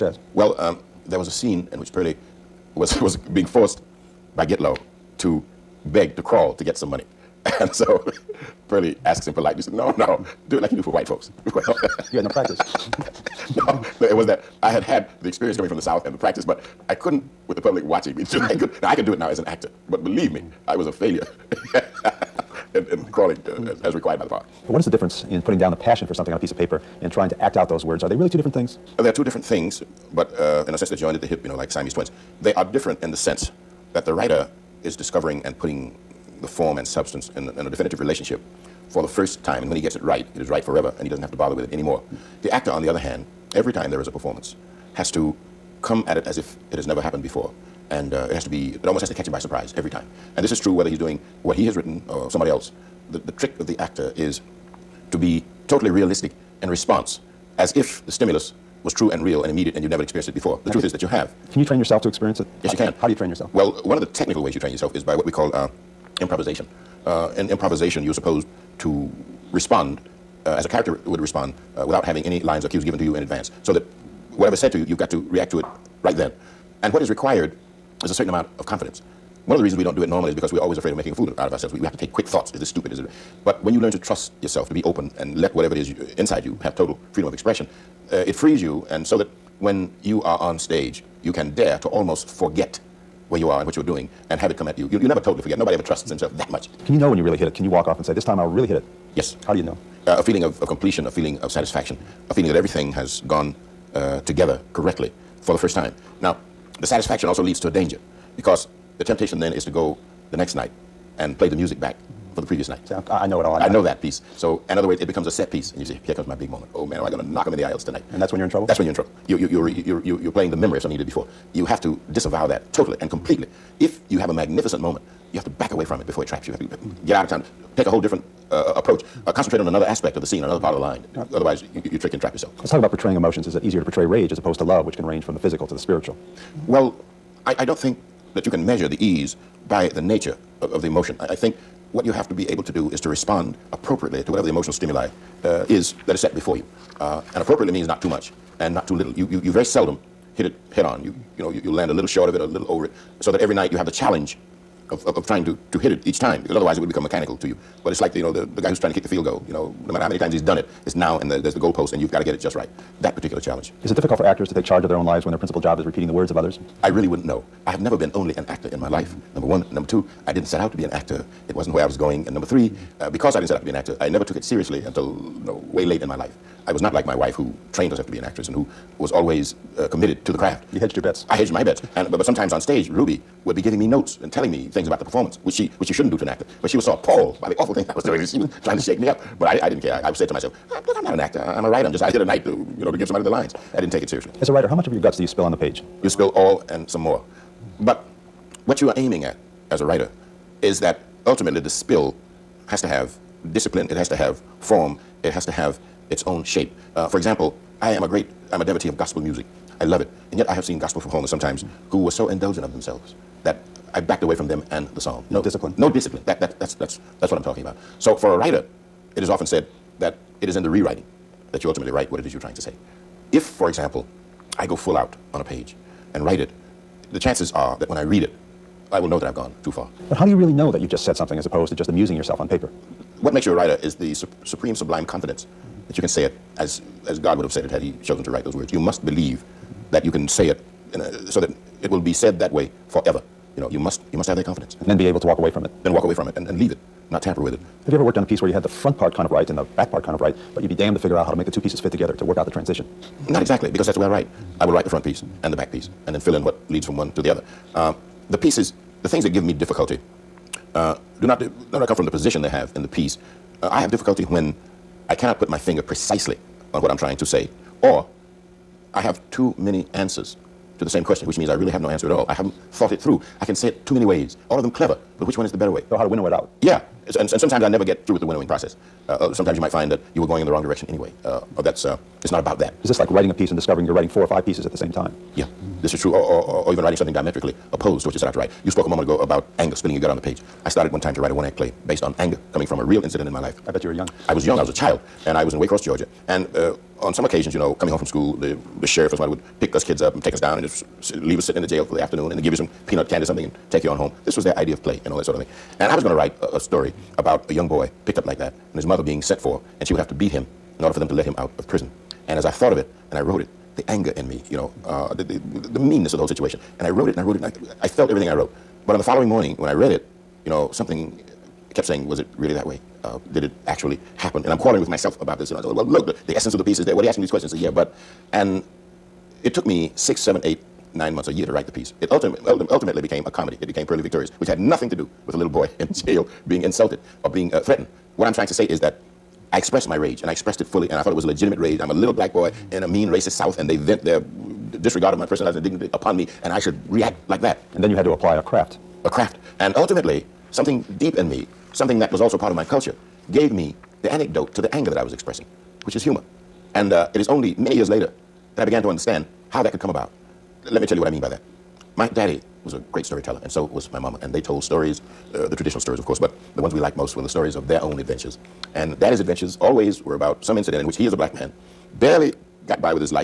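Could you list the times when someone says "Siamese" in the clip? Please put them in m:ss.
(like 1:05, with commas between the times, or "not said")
0:31.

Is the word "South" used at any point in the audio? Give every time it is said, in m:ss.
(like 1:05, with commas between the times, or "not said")
0:15, 5:43.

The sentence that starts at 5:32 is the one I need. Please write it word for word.
It ultimately, ultimately became a comedy.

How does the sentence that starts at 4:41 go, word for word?
Uh, oh, that's, uh, it's not about that.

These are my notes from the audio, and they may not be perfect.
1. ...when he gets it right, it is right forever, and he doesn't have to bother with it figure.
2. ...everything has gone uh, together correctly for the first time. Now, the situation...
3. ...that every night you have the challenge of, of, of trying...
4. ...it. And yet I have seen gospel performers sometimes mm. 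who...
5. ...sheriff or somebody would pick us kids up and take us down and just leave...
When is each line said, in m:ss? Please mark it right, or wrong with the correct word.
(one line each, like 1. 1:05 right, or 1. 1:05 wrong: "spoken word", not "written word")
1. 0:39 wrong: "anymore", not "figure"
2. 1:42 wrong: "satisfaction", not "situation"
3. 2:33 right
4. 3:30 right
5. 4:58 right.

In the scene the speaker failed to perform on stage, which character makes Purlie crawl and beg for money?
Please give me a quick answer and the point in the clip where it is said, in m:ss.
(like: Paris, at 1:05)
Gitlow, at 0:04.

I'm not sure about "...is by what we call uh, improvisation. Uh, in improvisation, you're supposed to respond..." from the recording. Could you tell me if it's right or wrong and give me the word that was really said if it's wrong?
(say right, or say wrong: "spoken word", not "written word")
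right.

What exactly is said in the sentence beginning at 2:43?
Is it difficult for actors to take charge of their own lives when their principal job is repeating the words of others?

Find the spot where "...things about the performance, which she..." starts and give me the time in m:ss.
3:04.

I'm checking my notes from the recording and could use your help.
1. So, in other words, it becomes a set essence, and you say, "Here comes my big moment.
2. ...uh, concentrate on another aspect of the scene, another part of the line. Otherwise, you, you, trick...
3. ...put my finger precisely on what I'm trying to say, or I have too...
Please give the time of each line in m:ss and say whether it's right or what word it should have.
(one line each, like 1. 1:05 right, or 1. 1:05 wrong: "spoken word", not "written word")
1. 1:54 wrong: "piece", not "essence"
2. 2:09 right
3. 4:25 right.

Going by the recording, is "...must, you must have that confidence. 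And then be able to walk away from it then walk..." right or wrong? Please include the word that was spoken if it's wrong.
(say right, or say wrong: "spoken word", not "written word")
right.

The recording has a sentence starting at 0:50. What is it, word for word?
And this is true whether he's doing what he has written or somebody else.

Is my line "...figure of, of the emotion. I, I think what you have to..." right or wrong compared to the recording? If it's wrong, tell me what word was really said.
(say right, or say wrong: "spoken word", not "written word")
wrong: "nature", not "figure".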